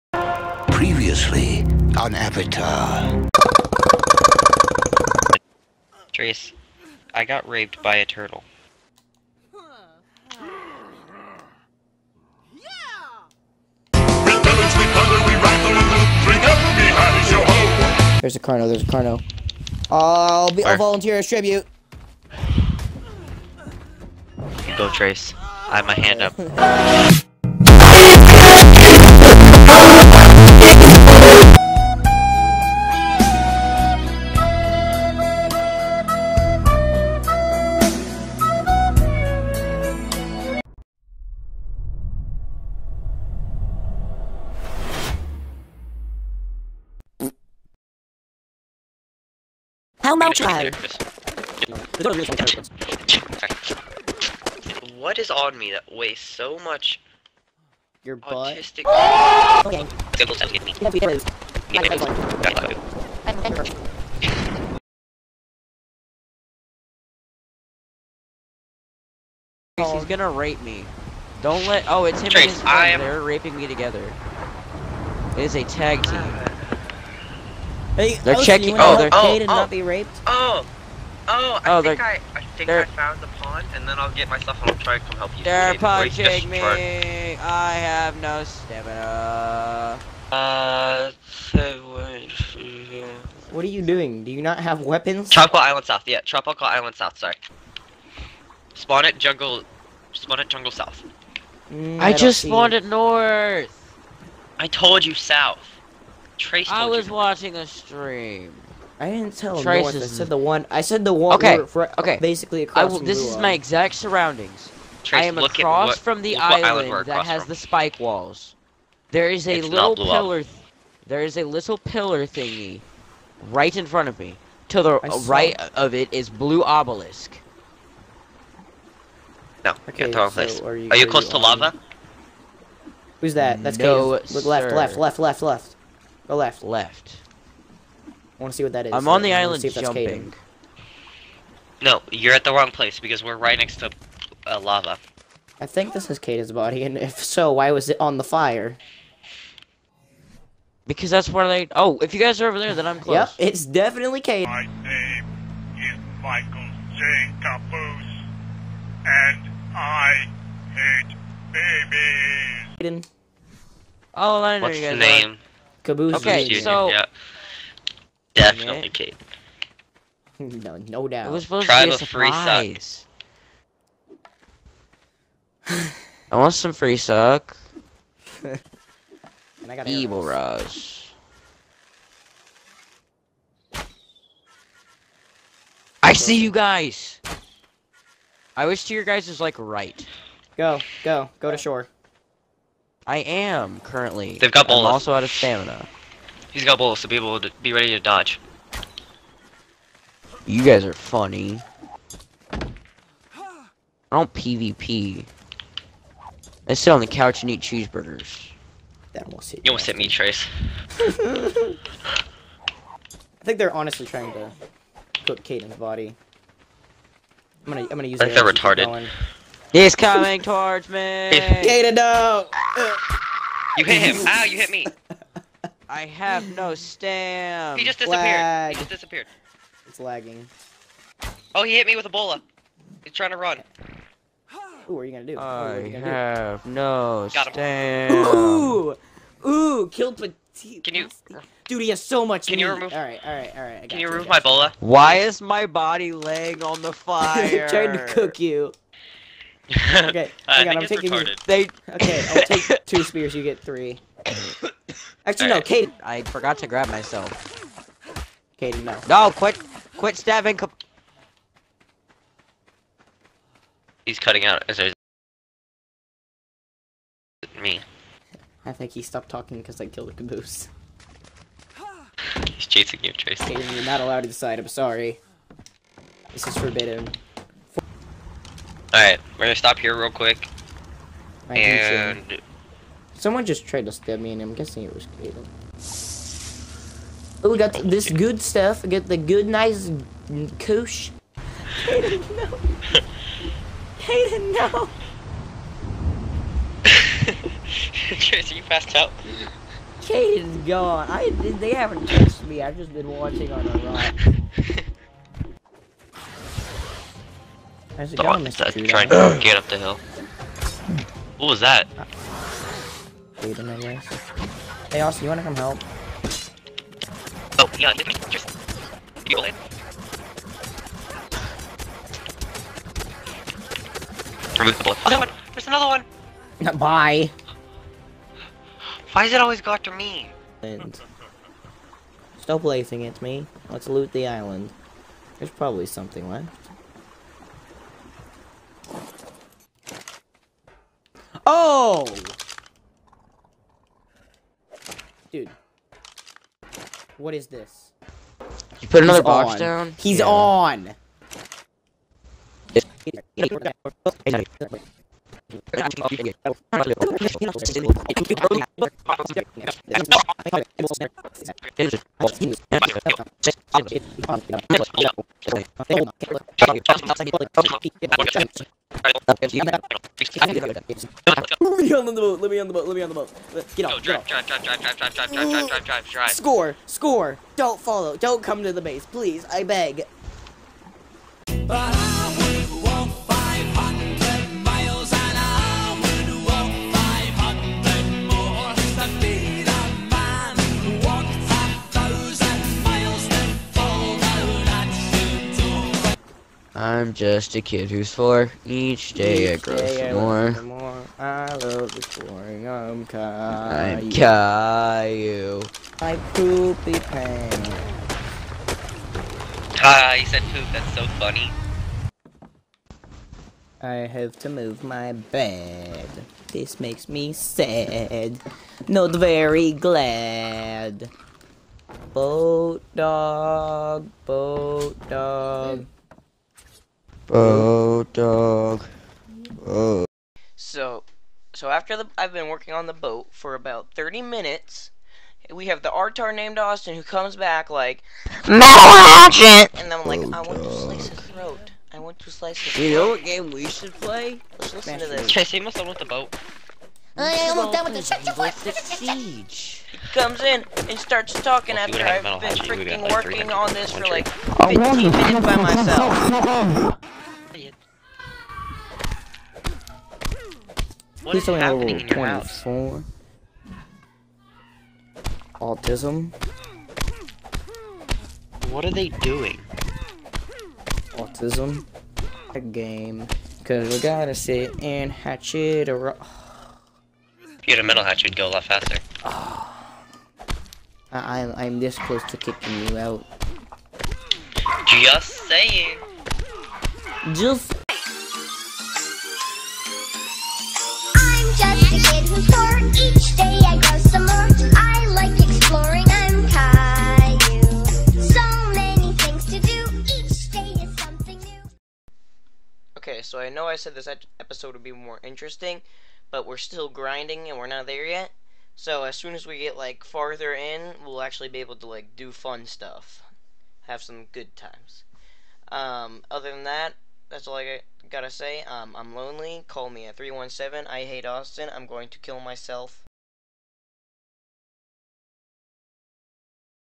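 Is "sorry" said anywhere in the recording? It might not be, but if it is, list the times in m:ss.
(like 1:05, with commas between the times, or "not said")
1:37, 4:34.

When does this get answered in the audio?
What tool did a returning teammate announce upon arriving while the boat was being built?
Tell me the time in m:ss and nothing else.
7:18.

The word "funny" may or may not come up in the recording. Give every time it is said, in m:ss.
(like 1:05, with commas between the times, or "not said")
3:20, 6:51.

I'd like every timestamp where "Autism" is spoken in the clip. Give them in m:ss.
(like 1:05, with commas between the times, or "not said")
7:45, 7:51.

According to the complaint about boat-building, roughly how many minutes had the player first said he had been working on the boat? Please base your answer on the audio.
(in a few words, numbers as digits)
30.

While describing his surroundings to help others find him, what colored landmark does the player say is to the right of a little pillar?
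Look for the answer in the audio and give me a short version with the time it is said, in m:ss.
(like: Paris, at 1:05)
blue obelisk, at 2:06.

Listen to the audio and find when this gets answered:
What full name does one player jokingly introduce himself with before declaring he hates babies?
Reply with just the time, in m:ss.
2:36.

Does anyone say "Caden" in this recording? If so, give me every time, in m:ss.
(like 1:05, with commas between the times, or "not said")
3:35, 3:41.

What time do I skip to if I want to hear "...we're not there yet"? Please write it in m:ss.
8:27.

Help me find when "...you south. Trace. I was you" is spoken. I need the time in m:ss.
1:45.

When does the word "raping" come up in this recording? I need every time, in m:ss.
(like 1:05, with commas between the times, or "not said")
1:13.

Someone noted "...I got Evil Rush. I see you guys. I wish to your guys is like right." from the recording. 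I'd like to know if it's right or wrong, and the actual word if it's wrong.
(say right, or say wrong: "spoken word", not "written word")
right.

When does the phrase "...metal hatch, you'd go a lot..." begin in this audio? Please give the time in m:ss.
7:57.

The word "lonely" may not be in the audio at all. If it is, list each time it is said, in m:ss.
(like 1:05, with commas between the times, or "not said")
8:39.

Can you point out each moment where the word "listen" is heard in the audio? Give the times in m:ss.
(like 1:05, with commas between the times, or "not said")
7:24.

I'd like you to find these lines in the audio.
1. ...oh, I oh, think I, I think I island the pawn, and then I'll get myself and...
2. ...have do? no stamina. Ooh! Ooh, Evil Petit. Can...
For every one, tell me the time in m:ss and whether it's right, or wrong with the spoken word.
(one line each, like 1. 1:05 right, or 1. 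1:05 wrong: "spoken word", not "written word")
1. 1:21 wrong: "found", not "island"
2. 3:56 wrong: "Killed", not "Evil".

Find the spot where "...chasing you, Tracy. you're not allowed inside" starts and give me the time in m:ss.
4:32.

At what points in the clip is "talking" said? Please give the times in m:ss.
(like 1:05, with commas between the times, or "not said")
4:29, 7:31.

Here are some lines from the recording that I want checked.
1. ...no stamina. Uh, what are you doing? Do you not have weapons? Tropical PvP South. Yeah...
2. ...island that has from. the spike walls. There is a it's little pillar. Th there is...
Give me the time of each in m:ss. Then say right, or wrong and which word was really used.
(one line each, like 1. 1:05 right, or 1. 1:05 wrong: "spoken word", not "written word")
1. 1:28 wrong: "Island", not "PvP"
2. 1:56 right.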